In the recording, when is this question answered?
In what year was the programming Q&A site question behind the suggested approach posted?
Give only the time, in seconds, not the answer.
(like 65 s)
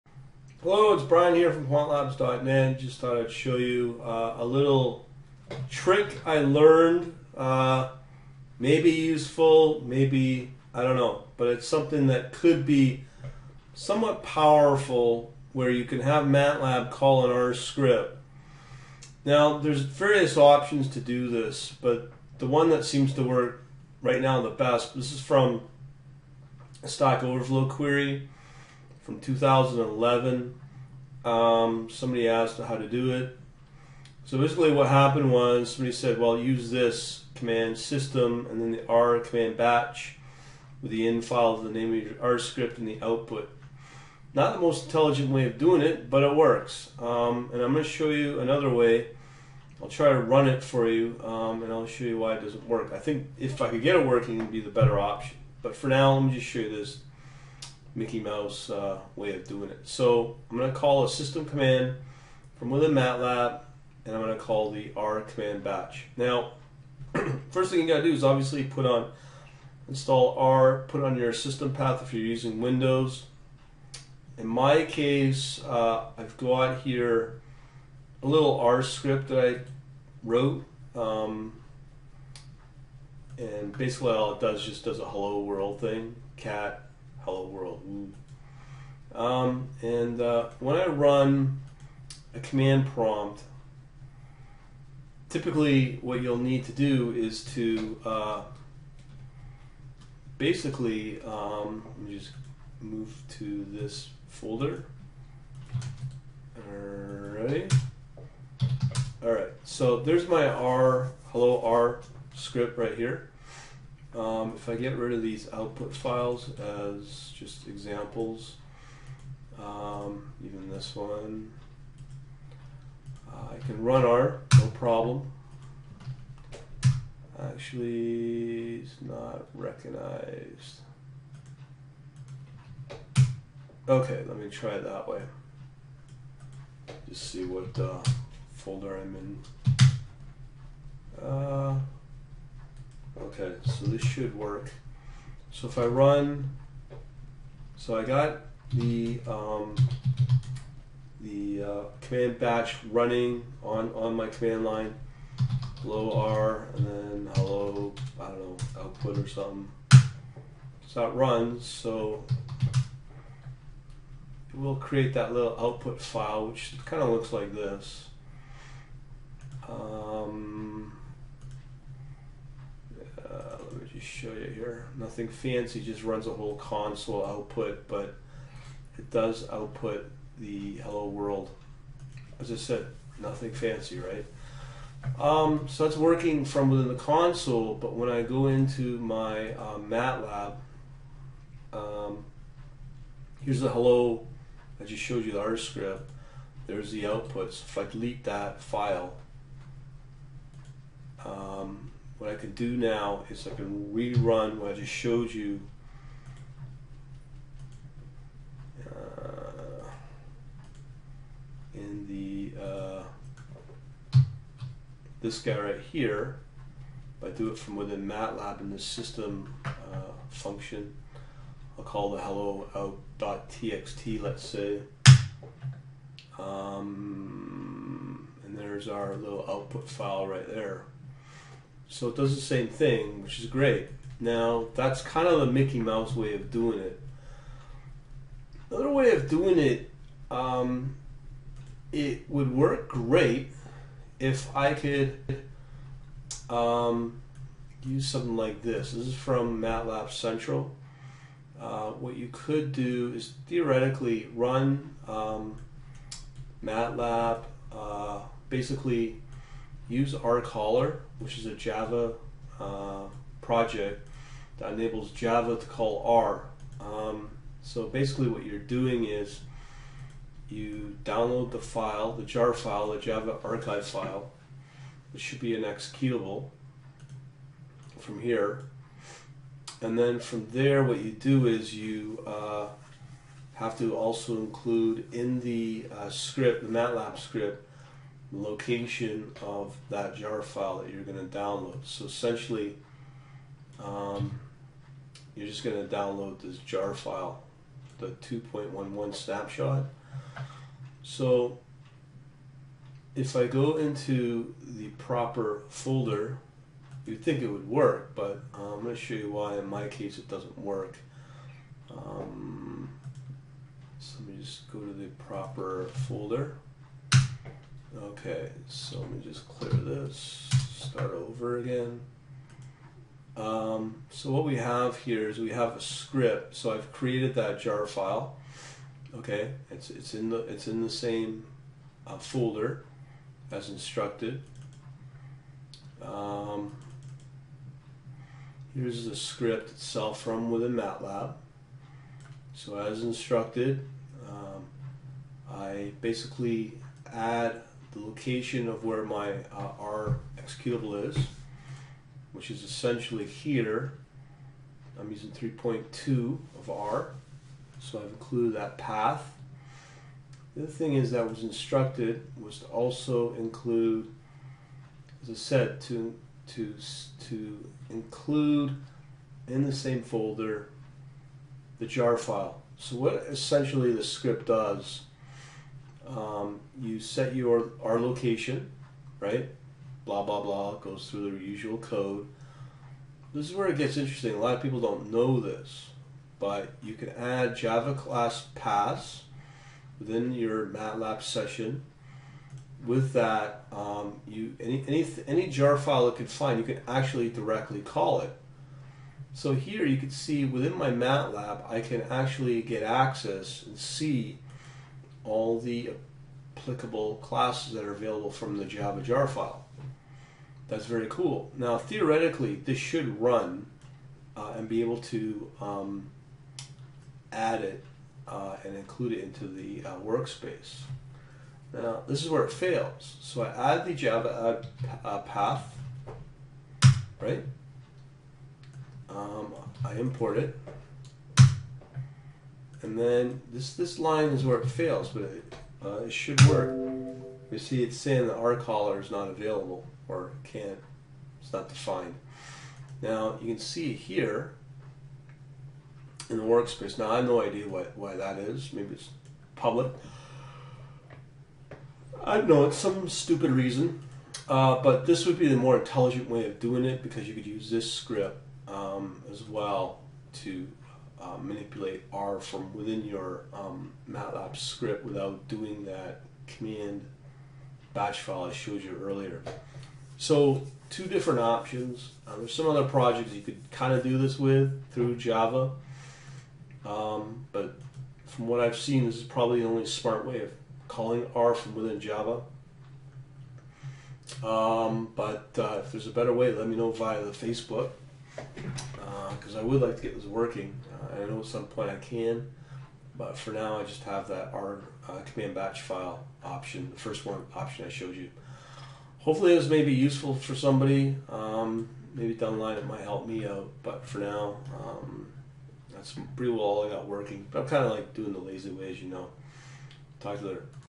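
29 s.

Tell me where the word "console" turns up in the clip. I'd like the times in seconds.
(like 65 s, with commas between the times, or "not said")
176 s, 186 s.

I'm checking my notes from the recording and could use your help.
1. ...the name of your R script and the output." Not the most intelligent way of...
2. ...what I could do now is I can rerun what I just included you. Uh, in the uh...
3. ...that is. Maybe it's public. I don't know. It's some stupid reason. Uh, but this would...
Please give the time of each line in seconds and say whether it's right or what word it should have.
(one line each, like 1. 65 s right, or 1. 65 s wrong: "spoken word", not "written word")
1. 41 s right
2. 202 s wrong: "showed", not "included"
3. 448 s right.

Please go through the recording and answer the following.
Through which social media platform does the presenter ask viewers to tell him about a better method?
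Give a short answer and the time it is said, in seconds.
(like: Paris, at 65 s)
Facebook, at 487 s.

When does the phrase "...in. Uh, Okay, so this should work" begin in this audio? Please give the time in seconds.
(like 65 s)
139 s.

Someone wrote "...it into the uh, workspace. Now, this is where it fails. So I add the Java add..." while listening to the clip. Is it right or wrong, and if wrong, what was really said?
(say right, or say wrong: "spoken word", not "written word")
right.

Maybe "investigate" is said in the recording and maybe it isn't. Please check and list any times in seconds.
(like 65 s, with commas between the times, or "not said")
not said.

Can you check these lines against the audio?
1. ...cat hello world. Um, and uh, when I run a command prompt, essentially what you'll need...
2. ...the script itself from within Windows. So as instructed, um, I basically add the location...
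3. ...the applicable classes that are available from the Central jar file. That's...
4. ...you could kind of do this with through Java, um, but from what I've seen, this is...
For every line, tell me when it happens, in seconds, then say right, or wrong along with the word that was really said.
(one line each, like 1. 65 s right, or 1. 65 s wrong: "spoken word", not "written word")
1. 86 s wrong: "typically", not "essentially"
2. 339 s wrong: "MATLAB", not "Windows"
3. 405 s wrong: "Java", not "Central"
4. 473 s right.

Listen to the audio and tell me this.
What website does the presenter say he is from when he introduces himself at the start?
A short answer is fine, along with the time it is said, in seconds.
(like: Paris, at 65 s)
quantlabs.net, at 1 s.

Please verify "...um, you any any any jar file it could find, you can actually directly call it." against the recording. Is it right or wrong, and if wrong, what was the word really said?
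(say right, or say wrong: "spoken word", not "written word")
right.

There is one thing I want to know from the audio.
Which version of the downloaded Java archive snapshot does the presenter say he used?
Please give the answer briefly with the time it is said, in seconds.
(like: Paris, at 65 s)
2.11, at 298 s.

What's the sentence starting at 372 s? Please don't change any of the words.
So what essentially the script does um, you set your R location, right?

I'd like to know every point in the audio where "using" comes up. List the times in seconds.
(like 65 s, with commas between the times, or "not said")
72 s, 355 s.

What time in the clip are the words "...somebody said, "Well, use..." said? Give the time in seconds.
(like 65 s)
35 s.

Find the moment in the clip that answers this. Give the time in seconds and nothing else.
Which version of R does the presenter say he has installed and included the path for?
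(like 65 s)
355 s.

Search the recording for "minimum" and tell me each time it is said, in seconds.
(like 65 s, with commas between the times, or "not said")
not said.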